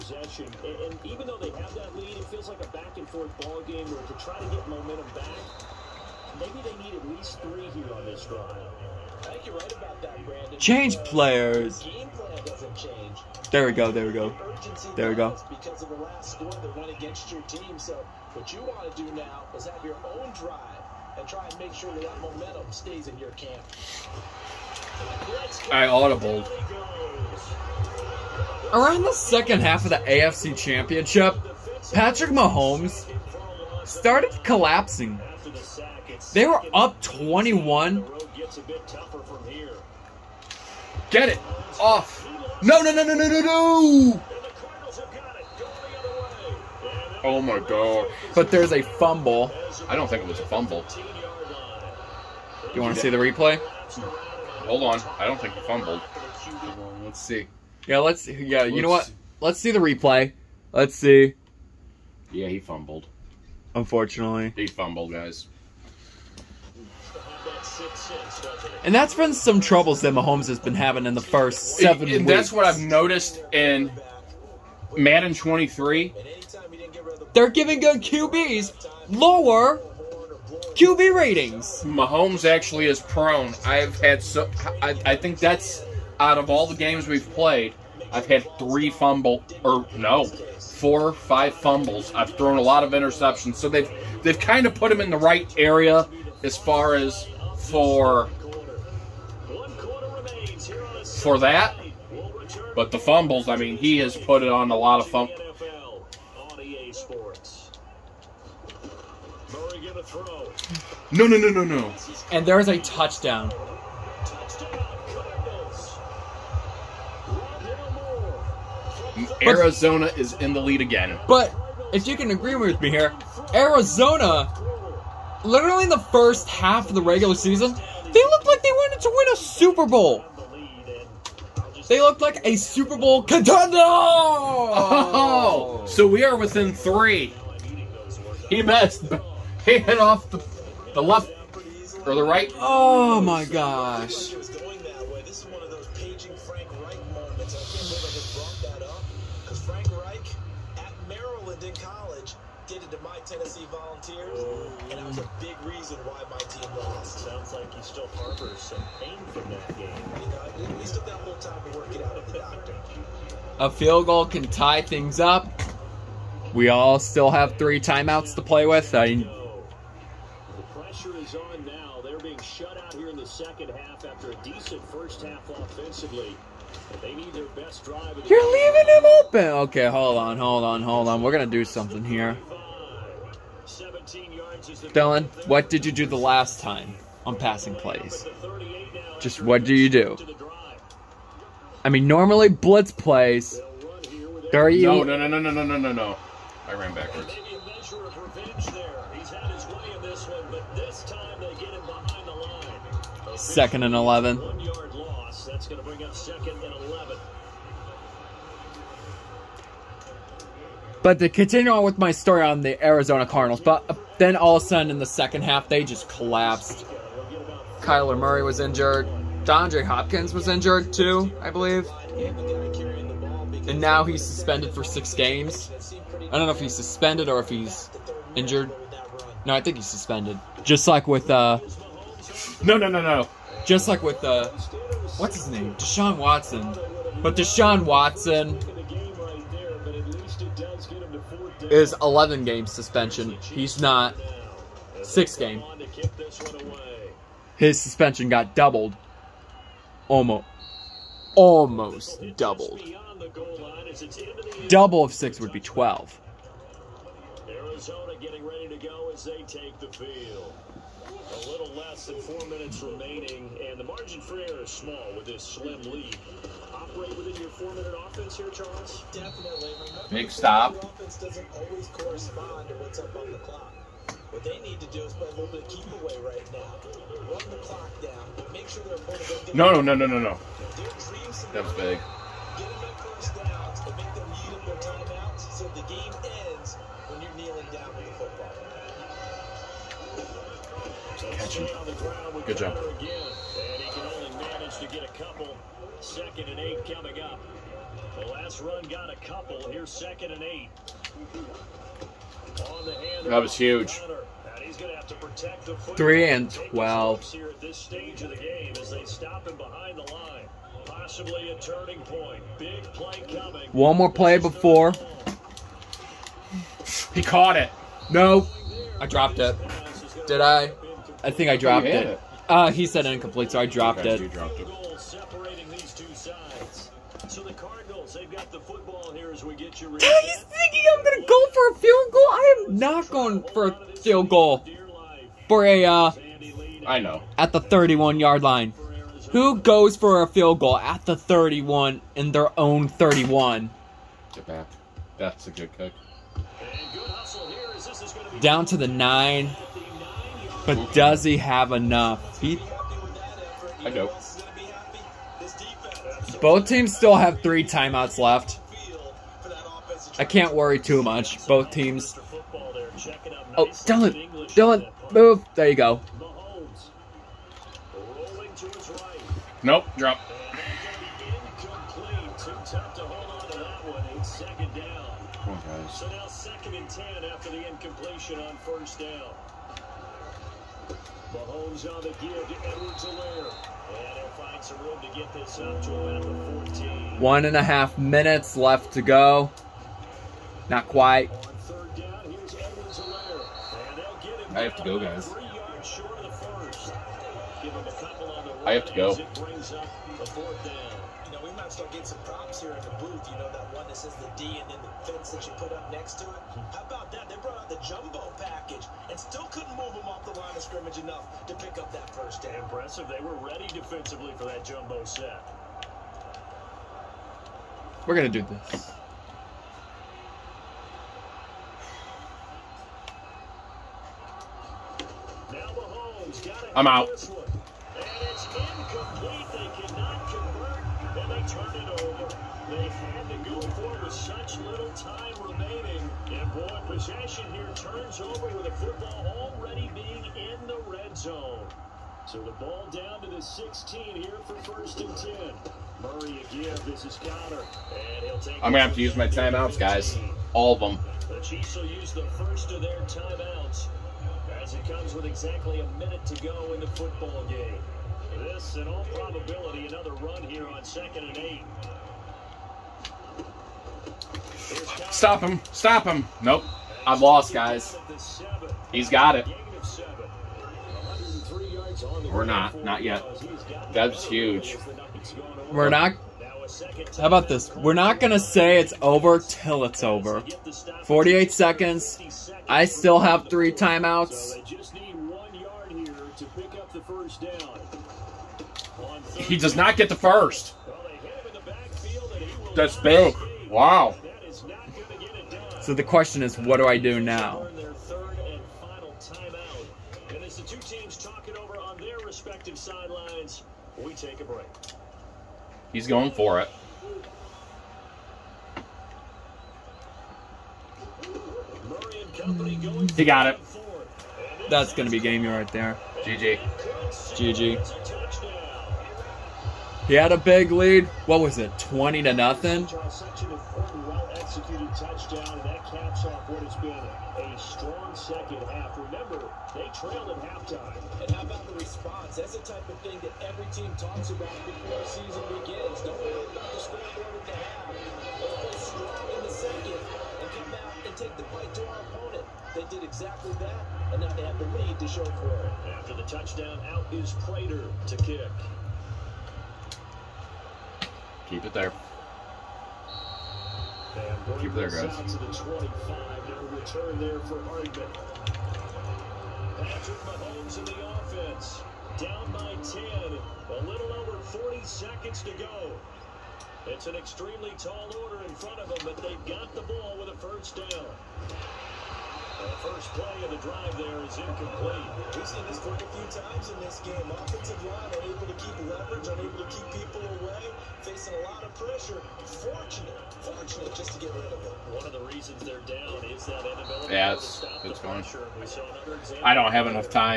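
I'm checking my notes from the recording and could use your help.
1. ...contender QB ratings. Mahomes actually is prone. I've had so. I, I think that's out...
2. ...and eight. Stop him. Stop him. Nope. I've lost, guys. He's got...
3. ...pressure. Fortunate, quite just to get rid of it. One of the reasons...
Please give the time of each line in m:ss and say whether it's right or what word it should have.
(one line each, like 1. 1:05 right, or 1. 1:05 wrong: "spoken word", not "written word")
1. 1:19 wrong: "lower", not "contender"
2. 7:41 right
3. 9:41 wrong: "fortunate", not "quite".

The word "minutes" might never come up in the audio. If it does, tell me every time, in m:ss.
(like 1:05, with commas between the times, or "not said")
4:22, 4:27, 6:27, 7:35.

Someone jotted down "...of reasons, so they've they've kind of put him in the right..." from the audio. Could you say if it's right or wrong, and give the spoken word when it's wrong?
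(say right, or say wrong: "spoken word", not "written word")
wrong: "interceptions", not "reasons".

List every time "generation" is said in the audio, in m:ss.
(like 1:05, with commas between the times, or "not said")
not said.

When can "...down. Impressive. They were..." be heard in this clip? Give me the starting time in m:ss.
6:52.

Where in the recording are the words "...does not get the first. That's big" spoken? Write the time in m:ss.
8:09.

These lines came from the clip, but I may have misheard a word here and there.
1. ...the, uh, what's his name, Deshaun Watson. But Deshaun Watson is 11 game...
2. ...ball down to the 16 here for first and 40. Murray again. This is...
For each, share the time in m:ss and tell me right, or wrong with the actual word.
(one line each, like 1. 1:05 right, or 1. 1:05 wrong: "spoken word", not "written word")
1. 3:54 right
2. 7:22 wrong: "10", not "40".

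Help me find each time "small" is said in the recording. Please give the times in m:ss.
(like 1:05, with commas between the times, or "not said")
4:24.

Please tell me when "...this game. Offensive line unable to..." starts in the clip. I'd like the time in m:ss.
9:36.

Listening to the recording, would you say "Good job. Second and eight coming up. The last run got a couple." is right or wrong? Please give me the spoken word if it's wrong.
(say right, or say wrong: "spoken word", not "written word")
right.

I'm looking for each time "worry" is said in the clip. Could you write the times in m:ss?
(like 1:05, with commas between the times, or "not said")
6:00, 8:56.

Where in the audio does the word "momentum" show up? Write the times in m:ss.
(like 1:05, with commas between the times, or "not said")
0:04, 0:22.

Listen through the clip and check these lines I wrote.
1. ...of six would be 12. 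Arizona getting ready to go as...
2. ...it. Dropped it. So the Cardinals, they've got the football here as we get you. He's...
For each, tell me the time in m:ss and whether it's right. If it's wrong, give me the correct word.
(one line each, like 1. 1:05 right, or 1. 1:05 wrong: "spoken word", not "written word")
1. 4:15 right
2. 5:24 right.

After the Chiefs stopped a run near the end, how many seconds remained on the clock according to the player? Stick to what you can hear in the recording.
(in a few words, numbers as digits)
48.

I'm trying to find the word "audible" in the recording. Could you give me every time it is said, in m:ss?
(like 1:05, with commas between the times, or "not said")
0:25.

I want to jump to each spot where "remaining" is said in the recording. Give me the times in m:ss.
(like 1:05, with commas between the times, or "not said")
4:22, 7:15.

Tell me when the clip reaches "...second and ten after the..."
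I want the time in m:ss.
6:16.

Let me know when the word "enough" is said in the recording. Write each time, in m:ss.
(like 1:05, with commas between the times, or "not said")
5:51, 6:50, 9:49.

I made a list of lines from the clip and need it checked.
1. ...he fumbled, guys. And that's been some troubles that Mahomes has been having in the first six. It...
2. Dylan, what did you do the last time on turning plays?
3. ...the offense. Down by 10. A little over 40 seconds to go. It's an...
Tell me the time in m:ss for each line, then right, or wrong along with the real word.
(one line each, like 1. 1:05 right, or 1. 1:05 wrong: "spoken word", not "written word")
1. 1:04 wrong: "seven", not "six"
2. 3:04 wrong: "passing", not "turning"
3. 9:20 right.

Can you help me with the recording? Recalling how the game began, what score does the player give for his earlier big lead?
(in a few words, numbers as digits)
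20 to 0.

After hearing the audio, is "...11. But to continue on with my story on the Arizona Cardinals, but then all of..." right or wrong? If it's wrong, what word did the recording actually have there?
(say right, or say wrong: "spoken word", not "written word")
right.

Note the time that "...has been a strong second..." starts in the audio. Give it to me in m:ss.
8:46.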